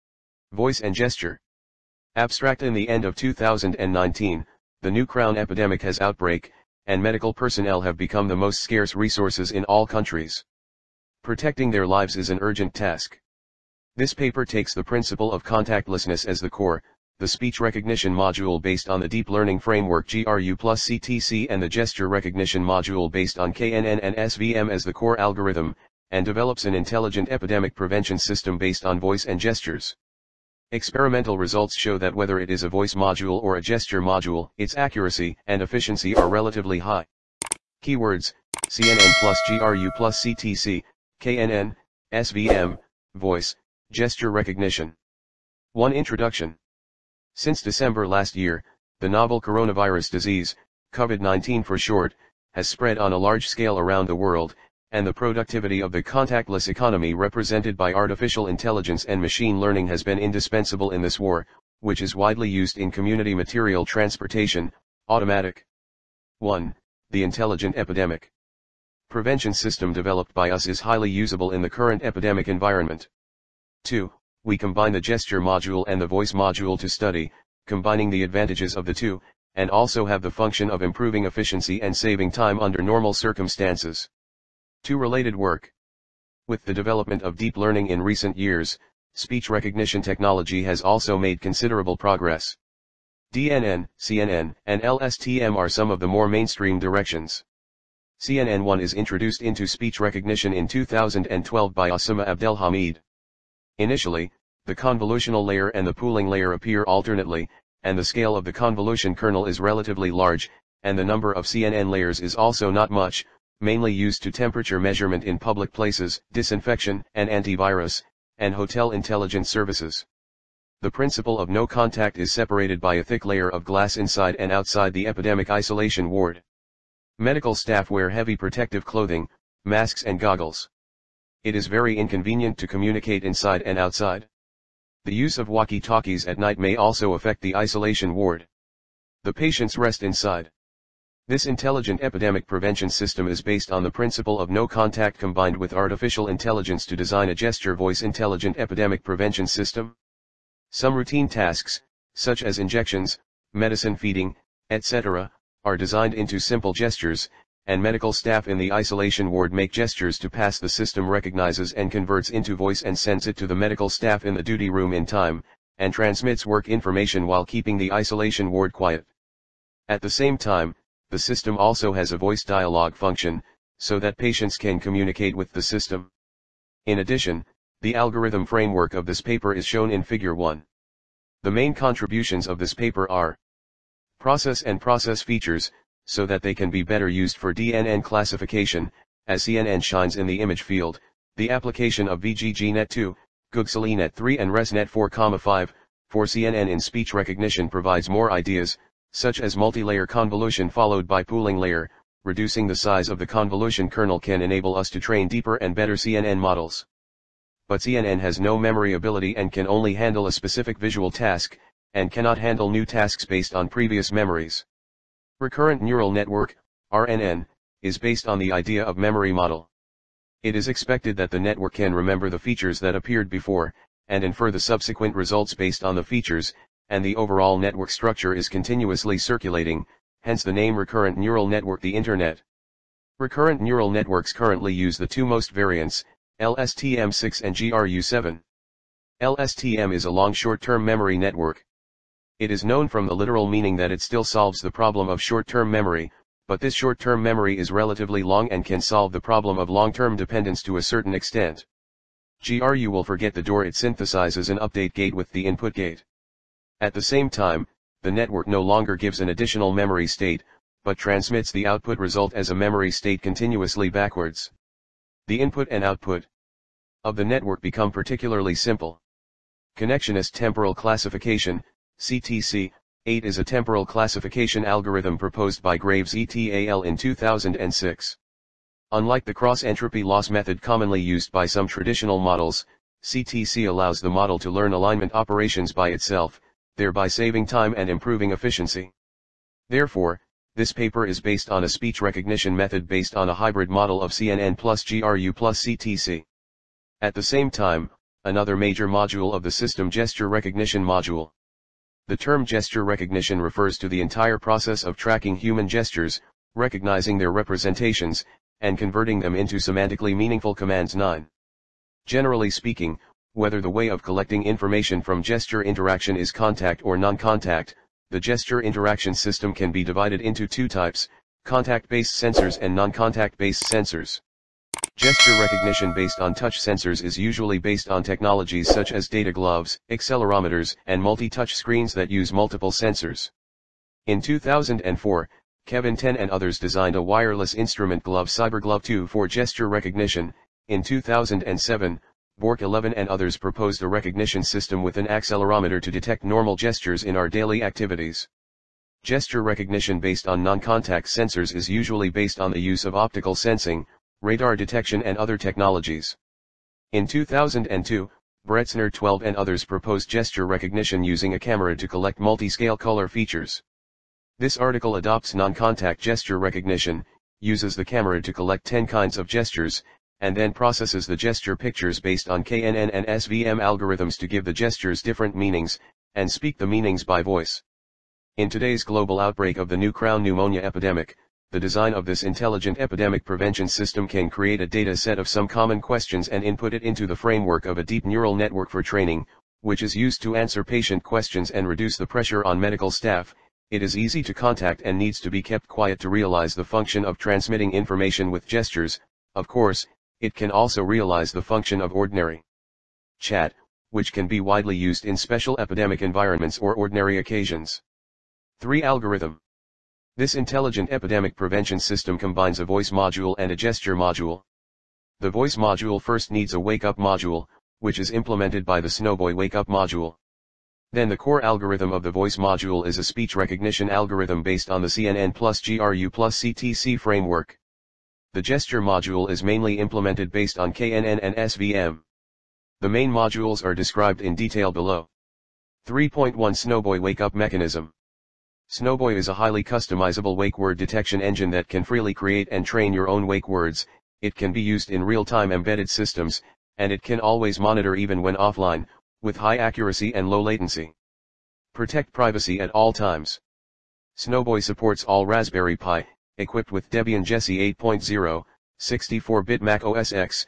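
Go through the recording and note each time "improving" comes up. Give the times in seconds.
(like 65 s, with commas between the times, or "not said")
80 s, 287 s.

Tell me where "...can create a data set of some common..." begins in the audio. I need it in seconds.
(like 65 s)
384 s.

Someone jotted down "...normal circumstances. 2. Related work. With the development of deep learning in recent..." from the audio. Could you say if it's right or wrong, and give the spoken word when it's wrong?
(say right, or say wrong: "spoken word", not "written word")
right.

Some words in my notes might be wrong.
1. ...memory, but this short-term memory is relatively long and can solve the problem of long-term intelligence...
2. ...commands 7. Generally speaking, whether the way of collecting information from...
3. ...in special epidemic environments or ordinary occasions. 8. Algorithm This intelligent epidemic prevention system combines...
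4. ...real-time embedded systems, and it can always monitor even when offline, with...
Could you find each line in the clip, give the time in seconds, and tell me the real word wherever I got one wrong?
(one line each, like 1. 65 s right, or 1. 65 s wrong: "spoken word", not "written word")
1. 245 s wrong: "dependence", not "intelligence"
2. 310 s wrong: "9", not "7"
3. 405 s wrong: "3", not "8"
4. 445 s right.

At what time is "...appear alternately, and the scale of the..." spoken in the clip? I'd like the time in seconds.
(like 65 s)
106 s.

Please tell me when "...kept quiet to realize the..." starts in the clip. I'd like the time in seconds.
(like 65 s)
395 s.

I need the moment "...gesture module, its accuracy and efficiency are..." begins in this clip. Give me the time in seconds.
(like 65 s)
33 s.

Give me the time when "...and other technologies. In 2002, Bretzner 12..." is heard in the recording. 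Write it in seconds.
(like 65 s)
355 s.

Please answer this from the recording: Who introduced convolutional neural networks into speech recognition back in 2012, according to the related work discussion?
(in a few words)
Osama Abdelhamid.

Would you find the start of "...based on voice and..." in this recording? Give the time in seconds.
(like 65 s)
28 s.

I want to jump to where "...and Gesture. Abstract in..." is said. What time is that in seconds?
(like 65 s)
0 s.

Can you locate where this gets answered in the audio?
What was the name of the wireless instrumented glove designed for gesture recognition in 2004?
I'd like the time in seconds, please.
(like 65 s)
338 s.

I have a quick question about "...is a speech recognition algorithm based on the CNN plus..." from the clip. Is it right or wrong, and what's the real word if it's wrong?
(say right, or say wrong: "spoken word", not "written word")
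right.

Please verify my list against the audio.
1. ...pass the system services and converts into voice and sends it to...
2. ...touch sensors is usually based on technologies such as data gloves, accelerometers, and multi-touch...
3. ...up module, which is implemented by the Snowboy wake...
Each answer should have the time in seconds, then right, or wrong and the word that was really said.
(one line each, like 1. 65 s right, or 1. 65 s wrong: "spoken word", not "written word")
1. 160 s wrong: "recognizes", not "services"
2. 326 s right
3. 416 s right.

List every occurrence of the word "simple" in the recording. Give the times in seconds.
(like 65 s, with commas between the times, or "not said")
156 s, 268 s.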